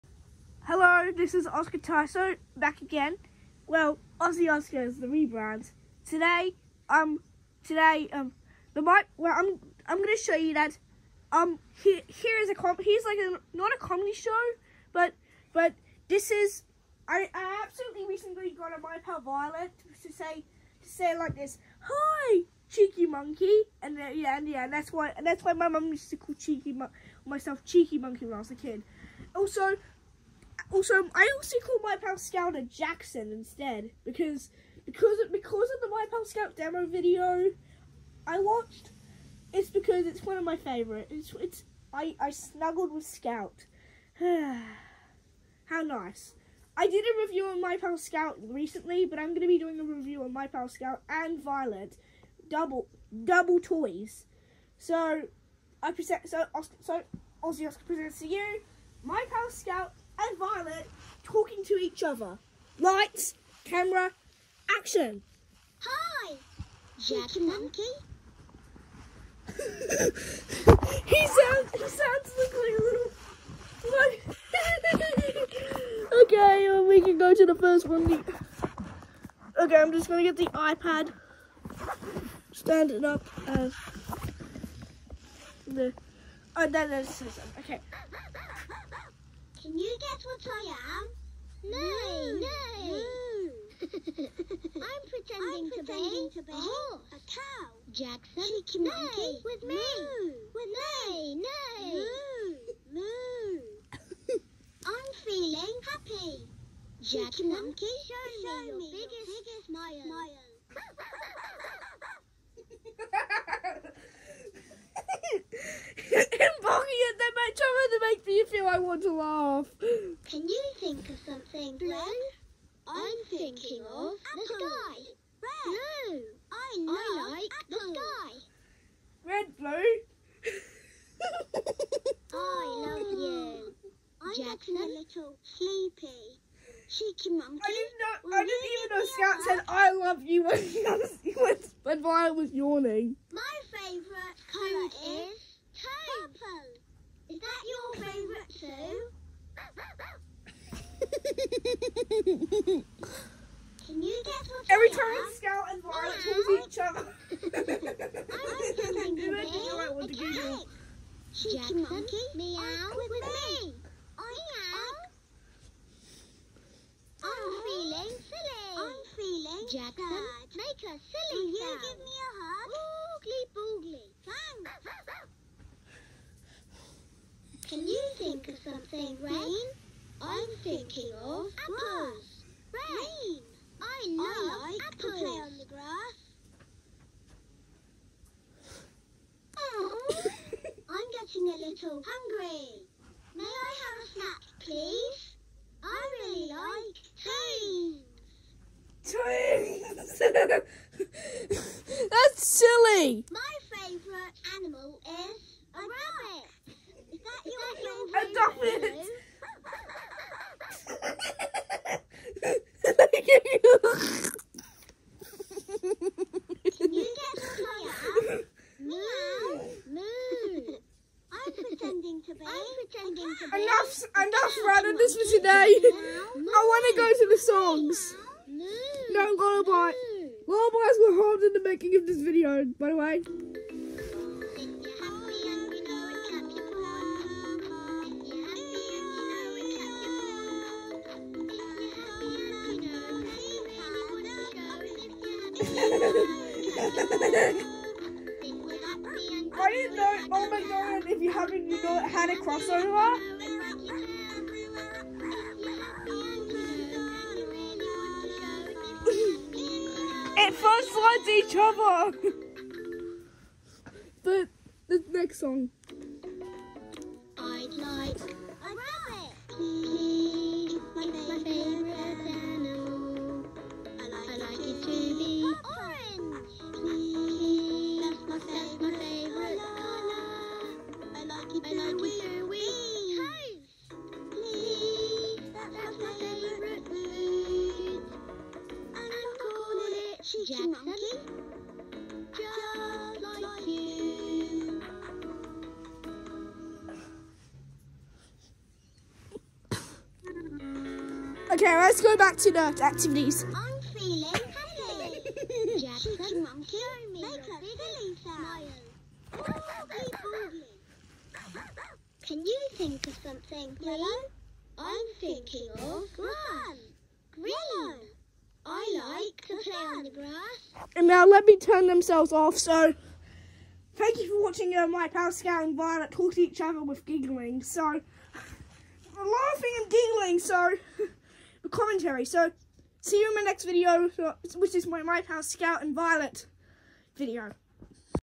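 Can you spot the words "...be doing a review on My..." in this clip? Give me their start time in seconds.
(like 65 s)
49 s.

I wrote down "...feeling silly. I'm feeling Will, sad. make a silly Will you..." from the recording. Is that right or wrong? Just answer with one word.
wrong.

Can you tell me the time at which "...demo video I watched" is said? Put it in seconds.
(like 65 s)
36 s.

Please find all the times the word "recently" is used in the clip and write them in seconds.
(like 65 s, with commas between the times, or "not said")
18 s, 48 s.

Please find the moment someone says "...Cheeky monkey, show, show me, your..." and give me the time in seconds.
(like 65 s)
107 s.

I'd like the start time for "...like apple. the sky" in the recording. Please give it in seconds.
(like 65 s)
127 s.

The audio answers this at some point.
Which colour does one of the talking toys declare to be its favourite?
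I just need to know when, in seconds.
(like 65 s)
145 s.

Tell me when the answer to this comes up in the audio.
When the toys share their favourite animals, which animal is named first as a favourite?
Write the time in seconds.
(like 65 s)
205 s.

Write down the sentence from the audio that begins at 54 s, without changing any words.
So I present so so Aussie Oscar presents to you My Pal Scout and Violet talking to each other.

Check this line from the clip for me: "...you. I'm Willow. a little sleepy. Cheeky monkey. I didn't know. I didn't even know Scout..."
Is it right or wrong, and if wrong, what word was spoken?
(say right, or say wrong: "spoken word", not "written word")
wrong: "Jackson", not "Willow".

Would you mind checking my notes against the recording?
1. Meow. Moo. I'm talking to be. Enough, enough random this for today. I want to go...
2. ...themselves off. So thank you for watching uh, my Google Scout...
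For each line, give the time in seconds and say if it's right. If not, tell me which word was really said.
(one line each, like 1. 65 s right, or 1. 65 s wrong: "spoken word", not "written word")
1. 218 s wrong: "pretending", not "talking"
2. 321 s wrong: "Pal", not "Google".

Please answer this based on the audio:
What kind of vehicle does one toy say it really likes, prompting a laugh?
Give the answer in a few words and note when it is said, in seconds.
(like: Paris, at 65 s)
Trains, at 195 s.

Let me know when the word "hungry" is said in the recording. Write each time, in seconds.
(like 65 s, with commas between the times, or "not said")
192 s.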